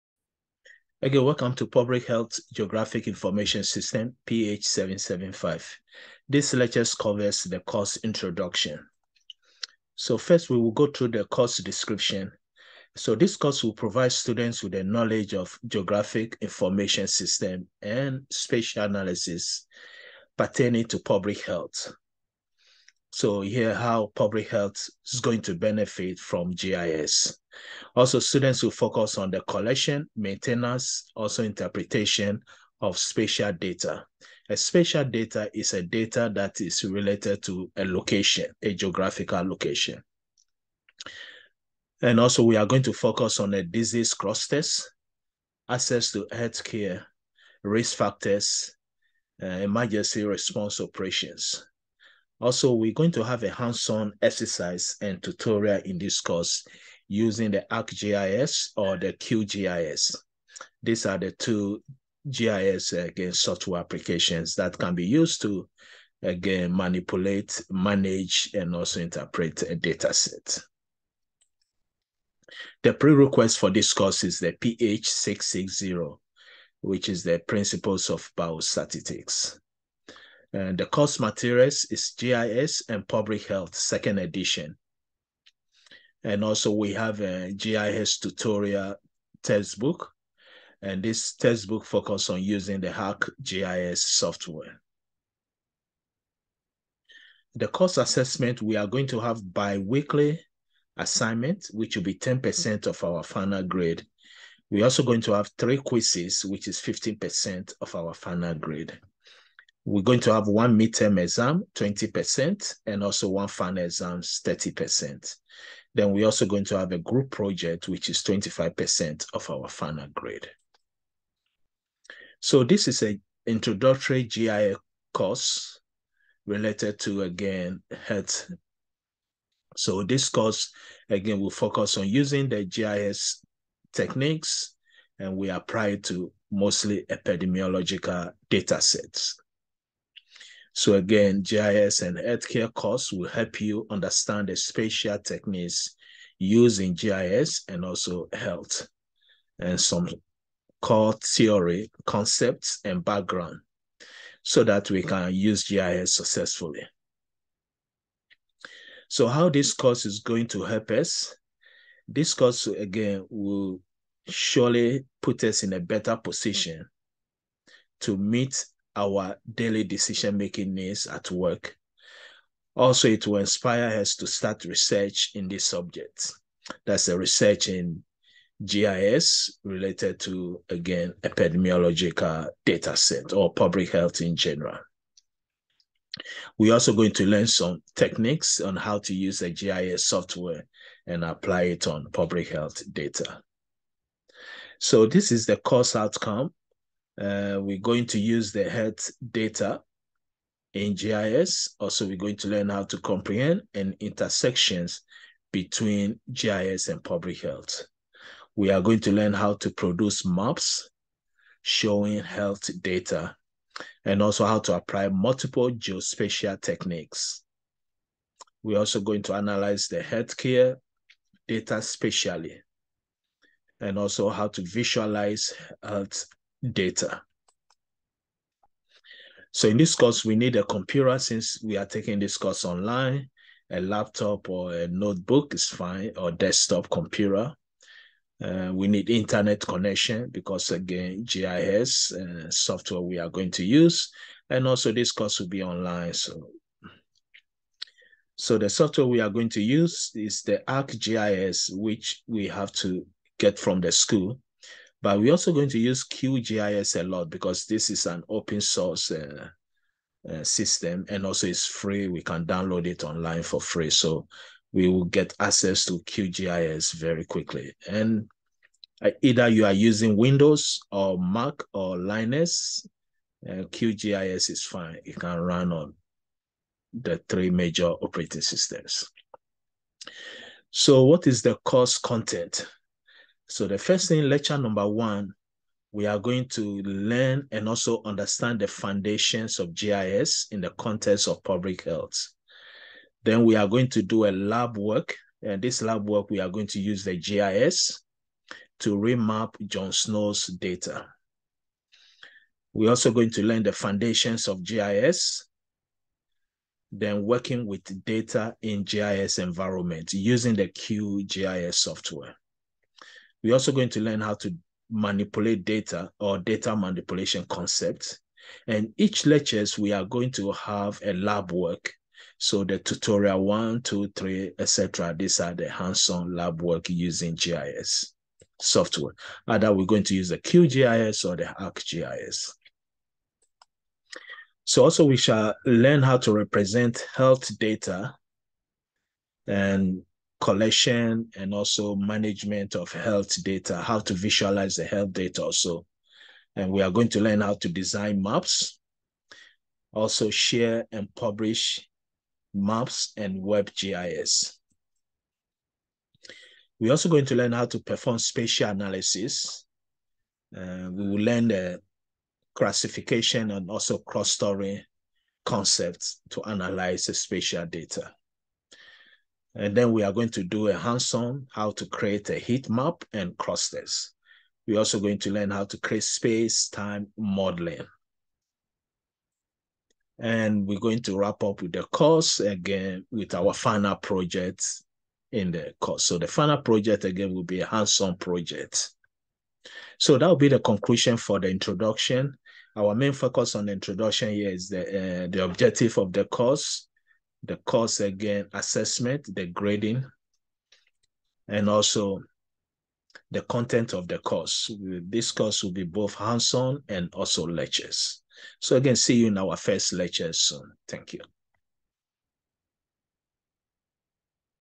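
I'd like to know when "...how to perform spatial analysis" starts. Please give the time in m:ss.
5:57.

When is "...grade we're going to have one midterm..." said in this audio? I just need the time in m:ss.
1:48.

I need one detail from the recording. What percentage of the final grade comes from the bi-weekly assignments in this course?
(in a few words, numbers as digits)
10%.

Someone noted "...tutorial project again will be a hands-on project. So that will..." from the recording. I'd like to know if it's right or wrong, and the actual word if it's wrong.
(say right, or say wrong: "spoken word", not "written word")
wrong: "final", not "tutorial".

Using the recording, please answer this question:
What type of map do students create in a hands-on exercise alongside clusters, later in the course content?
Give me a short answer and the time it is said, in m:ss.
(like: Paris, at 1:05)
heat map, at 6:12.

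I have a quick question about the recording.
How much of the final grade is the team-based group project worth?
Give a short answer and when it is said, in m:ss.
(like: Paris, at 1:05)
25%, at 1:58.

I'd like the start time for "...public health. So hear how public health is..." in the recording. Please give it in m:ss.
0:20.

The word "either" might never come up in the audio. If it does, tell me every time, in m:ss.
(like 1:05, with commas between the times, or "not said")
4:29, 5:29.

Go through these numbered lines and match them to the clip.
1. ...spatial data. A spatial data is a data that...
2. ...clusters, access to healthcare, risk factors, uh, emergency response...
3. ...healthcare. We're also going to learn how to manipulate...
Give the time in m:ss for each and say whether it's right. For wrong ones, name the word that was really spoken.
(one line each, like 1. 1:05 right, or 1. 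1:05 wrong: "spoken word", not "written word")
1. 0:32 right
2. 0:44 right
3. 5:11 wrong: "software", not "healthcare".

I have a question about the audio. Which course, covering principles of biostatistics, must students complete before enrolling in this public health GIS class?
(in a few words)
PH660.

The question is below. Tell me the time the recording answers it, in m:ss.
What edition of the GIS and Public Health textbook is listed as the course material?
1:23.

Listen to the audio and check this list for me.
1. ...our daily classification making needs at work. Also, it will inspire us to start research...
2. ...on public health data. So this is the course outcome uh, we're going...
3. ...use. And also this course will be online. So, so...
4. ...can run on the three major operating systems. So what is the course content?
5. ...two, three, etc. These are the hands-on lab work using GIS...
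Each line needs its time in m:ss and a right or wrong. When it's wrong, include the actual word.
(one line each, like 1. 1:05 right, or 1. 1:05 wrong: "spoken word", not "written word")
1. 2:48 wrong: "decision", not "classification"
2. 3:11 right
3. 4:03 right
4. 4:35 right
5. 5:23 right.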